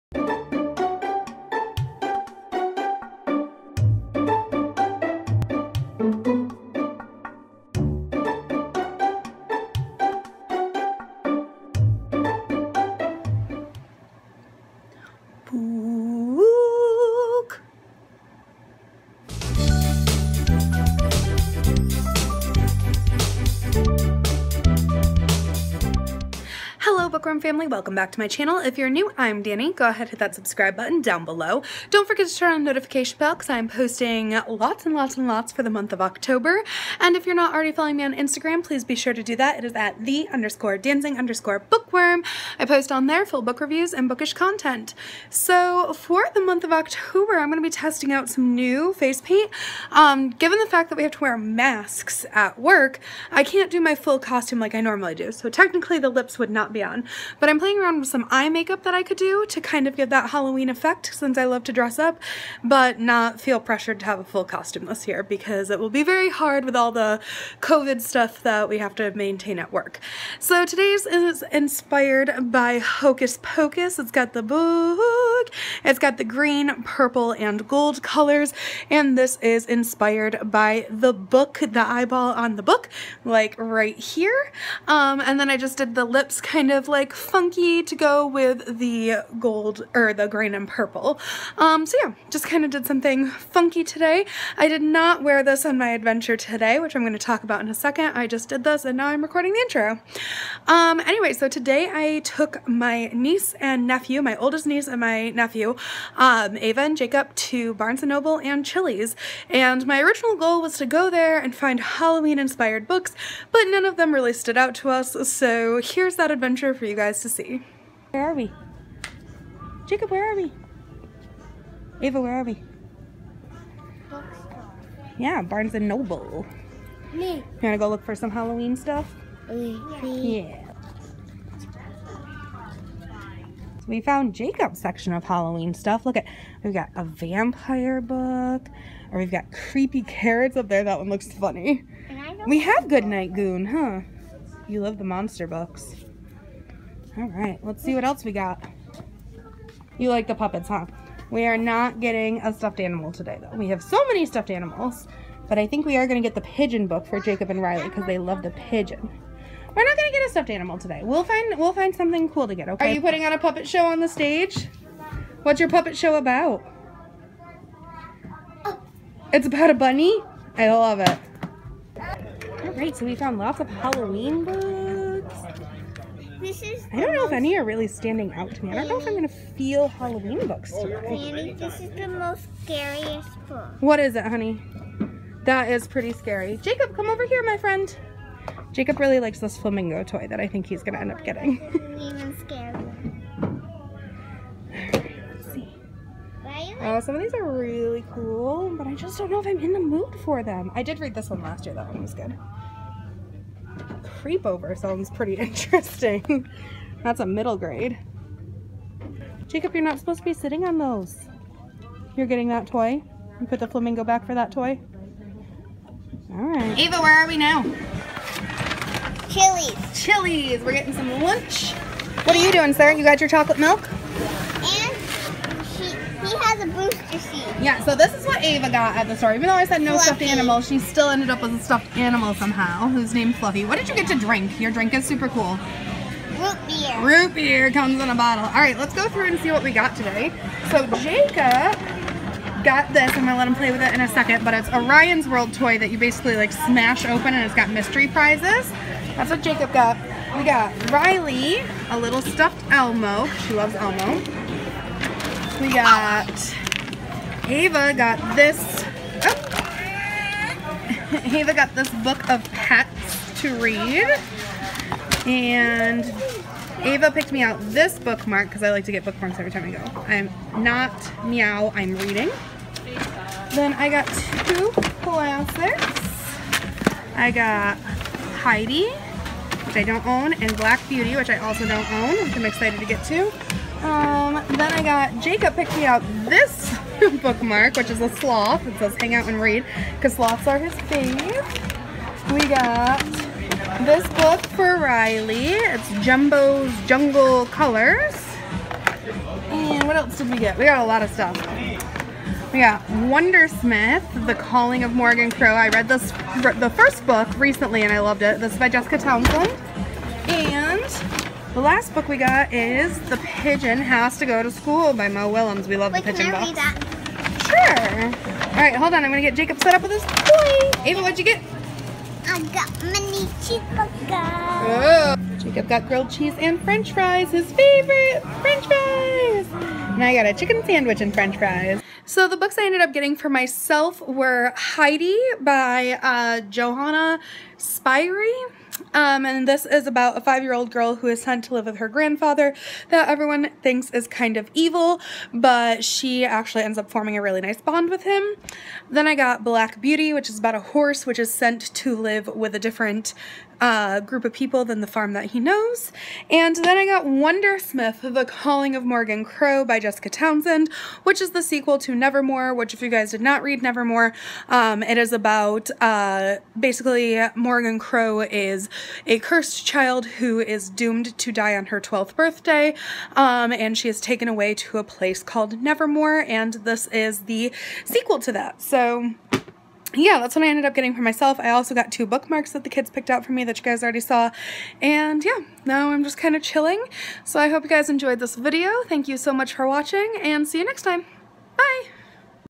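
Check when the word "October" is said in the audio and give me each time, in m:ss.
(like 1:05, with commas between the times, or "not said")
0:35, 0:46.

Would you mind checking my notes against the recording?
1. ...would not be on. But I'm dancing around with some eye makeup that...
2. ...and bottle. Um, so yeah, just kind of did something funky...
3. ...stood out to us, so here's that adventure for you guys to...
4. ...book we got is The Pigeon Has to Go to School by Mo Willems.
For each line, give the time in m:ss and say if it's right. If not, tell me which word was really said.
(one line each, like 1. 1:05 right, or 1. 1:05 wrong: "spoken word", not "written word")
1. 0:56 wrong: "playing", not "dancing"
2. 1:30 wrong: "purple", not "bottle"
3. 1:54 right
4. 5:11 right.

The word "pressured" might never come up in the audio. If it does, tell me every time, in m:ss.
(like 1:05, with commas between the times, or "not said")
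1:03.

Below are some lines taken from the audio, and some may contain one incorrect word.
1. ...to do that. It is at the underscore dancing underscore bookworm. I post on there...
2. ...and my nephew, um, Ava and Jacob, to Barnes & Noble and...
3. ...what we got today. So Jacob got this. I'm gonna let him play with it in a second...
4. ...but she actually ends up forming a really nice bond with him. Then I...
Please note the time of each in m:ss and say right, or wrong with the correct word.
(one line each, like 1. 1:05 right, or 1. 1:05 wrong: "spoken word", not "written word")
1. 0:39 right
2. 1:44 right
3. 3:59 right
4. 5:45 right.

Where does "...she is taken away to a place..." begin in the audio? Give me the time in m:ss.
6:13.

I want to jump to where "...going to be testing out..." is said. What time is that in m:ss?
0:47.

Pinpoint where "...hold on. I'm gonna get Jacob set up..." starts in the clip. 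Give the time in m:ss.
5:18.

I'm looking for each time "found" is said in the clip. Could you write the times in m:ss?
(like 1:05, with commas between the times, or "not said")
2:13, 2:53.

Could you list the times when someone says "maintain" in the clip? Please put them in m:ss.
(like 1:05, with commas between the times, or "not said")
1:09.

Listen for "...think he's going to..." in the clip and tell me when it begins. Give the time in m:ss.
3:10.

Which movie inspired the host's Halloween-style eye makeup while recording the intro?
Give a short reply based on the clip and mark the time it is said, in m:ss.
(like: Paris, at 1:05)
Hocus Pocus, at 1:12.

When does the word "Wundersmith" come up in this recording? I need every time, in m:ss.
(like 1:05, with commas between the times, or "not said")
5:02, 5:57.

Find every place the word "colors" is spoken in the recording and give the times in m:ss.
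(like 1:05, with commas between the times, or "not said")
1:18, 4:57.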